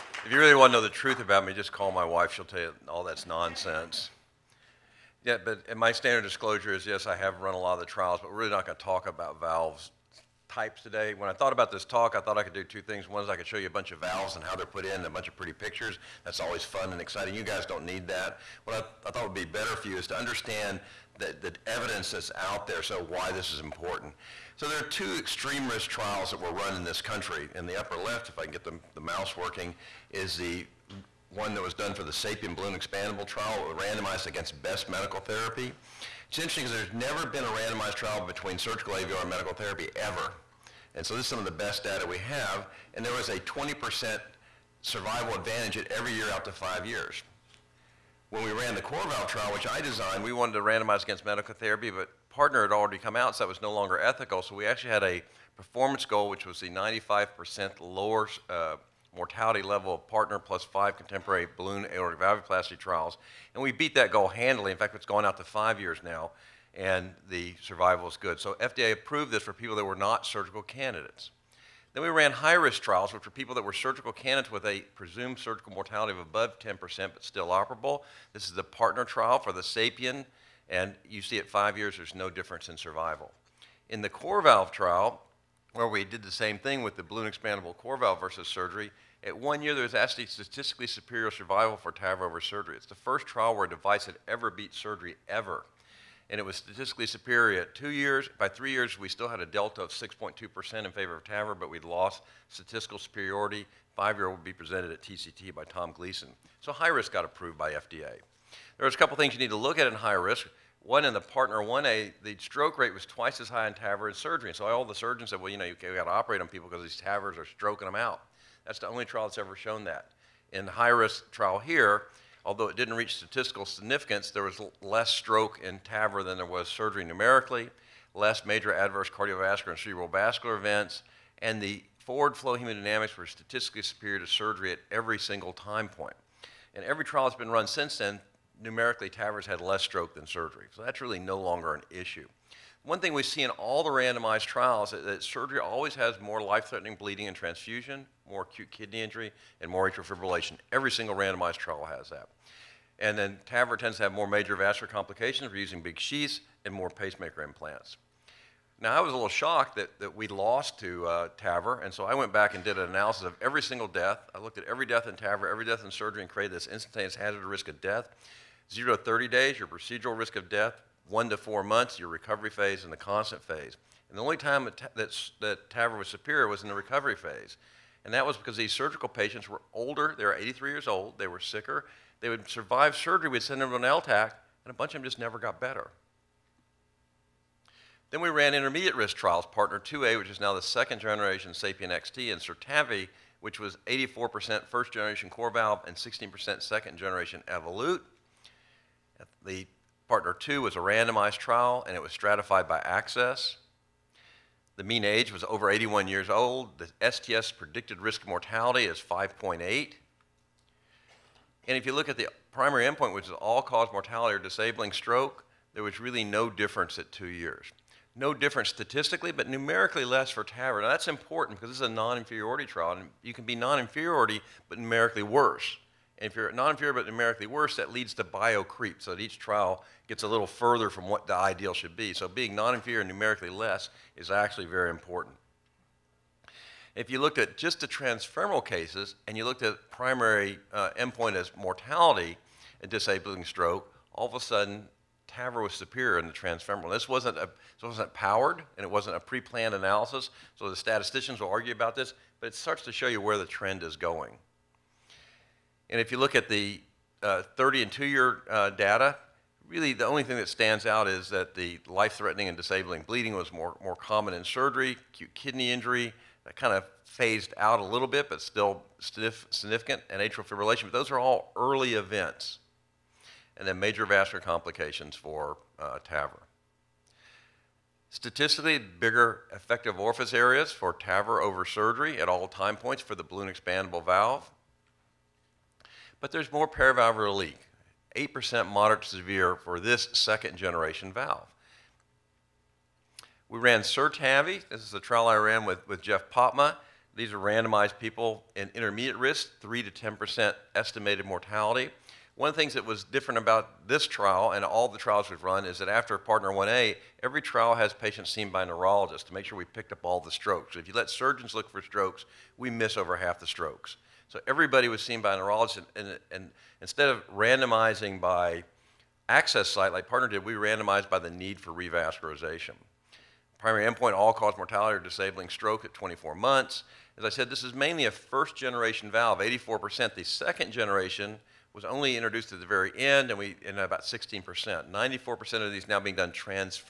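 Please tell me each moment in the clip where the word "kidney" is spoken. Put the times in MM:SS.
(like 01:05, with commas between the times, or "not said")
02:28, 04:25.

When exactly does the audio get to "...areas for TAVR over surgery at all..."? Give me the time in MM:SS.
04:40.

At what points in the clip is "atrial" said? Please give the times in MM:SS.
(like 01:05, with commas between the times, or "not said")
02:29, 04:30.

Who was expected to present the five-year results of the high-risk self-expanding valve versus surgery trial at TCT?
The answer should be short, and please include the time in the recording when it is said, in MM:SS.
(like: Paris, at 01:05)
Tom Gleason, at 01:45.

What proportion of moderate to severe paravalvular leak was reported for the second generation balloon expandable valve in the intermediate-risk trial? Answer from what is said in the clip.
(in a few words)
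8%.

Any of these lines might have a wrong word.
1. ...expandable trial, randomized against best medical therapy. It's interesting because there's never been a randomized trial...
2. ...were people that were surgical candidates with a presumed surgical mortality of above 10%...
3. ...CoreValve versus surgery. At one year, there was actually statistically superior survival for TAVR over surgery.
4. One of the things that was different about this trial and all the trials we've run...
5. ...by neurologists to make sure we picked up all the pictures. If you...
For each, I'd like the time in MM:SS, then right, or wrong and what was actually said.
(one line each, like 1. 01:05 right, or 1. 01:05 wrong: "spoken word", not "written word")
1. 00:32 right
2. 01:13 right
3. 01:27 right
4. 05:02 right
5. 05:08 wrong: "strokes", not "pictures".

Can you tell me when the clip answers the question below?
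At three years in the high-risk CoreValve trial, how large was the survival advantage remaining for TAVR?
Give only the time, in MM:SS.
01:39.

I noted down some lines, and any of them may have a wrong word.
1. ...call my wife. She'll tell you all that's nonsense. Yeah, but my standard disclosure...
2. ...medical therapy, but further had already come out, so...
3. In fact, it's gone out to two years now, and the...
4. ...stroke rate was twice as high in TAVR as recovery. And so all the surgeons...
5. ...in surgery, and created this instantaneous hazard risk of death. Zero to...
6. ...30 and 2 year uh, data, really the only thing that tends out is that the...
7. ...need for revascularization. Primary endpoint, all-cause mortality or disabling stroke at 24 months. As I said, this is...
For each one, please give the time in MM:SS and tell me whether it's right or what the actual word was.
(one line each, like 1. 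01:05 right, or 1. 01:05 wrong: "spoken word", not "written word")
1. 00:01 right
2. 00:51 wrong: "partner", not "further"
3. 01:04 wrong: "five", not "two"
4. 01:52 wrong: "surgery", not "recovery"
5. 02:45 right
6. 04:17 wrong: "stands", not "tends"
7. 05:21 right.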